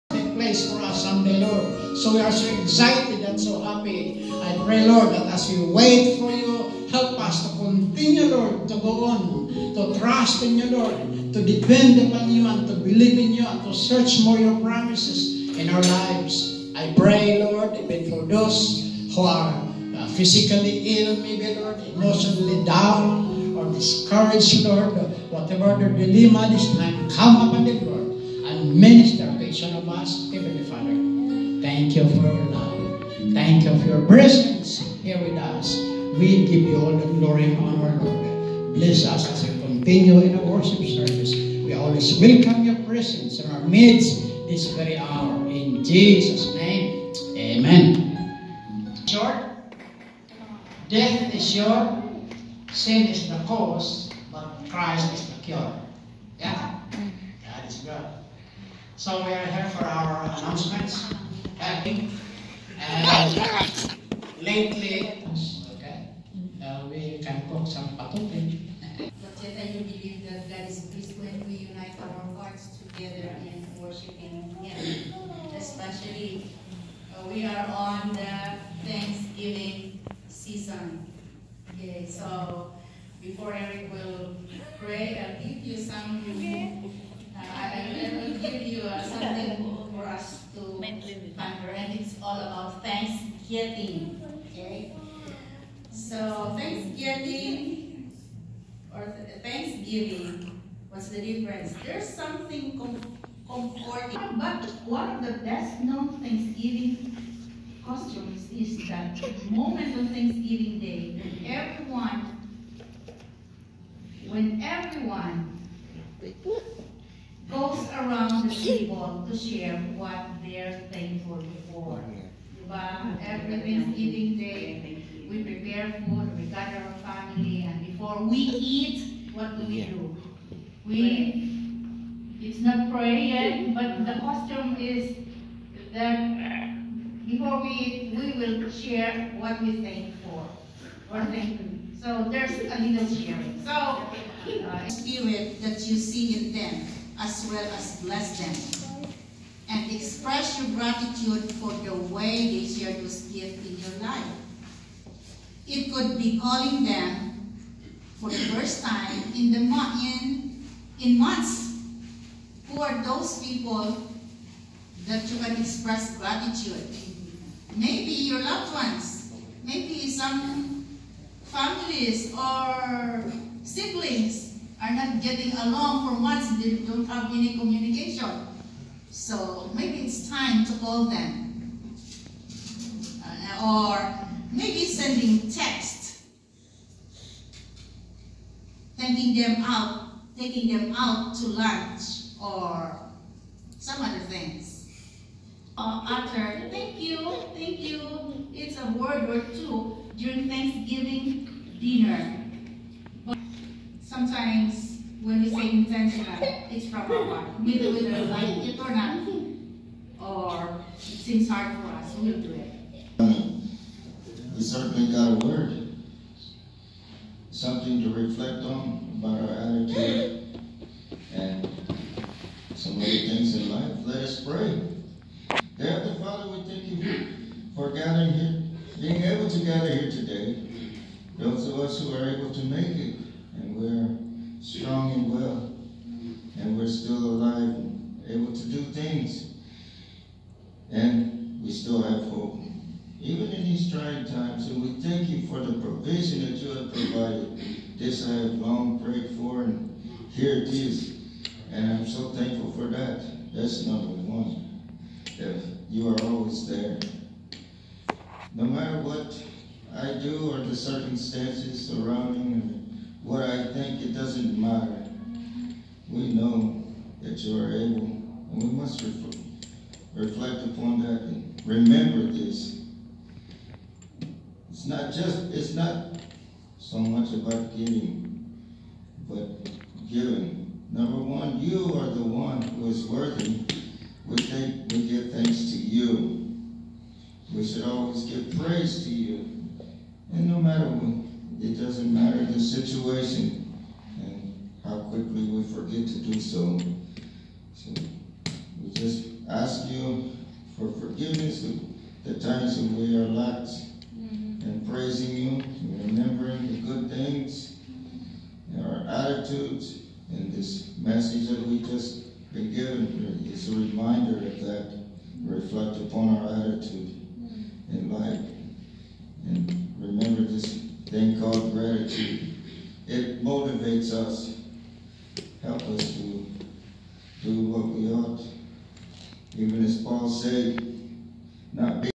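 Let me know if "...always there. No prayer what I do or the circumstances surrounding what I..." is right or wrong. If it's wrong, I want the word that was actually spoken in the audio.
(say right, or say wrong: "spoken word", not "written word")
wrong: "matter", not "prayer".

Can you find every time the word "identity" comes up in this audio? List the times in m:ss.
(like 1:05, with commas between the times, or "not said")
not said.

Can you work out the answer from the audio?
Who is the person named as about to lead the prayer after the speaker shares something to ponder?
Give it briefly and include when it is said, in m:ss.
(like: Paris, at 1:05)
Eric, at 1:23.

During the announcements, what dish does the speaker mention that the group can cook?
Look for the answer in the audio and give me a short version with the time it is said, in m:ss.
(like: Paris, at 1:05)
patutin, at 1:07.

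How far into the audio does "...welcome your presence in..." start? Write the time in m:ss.
0:42.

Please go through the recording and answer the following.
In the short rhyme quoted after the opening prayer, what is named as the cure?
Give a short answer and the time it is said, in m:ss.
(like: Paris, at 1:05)
Christ, at 0:54.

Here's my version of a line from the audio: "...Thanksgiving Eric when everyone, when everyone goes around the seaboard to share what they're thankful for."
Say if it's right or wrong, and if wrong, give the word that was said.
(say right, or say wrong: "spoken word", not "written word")
wrong: "Day", not "Eric".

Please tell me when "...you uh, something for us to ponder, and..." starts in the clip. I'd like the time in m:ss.
1:28.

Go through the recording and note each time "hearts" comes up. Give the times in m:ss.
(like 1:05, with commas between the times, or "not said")
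1:12, 3:27.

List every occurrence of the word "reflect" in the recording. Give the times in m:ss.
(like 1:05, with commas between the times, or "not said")
3:38, 4:30, 5:15.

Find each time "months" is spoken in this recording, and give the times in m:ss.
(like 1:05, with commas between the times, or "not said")
2:41, 2:56.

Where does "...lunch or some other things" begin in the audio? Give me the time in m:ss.
3:11.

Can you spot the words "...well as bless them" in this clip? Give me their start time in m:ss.
2:27.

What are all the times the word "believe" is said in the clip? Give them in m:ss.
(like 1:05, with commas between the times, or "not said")
0:12, 1:09.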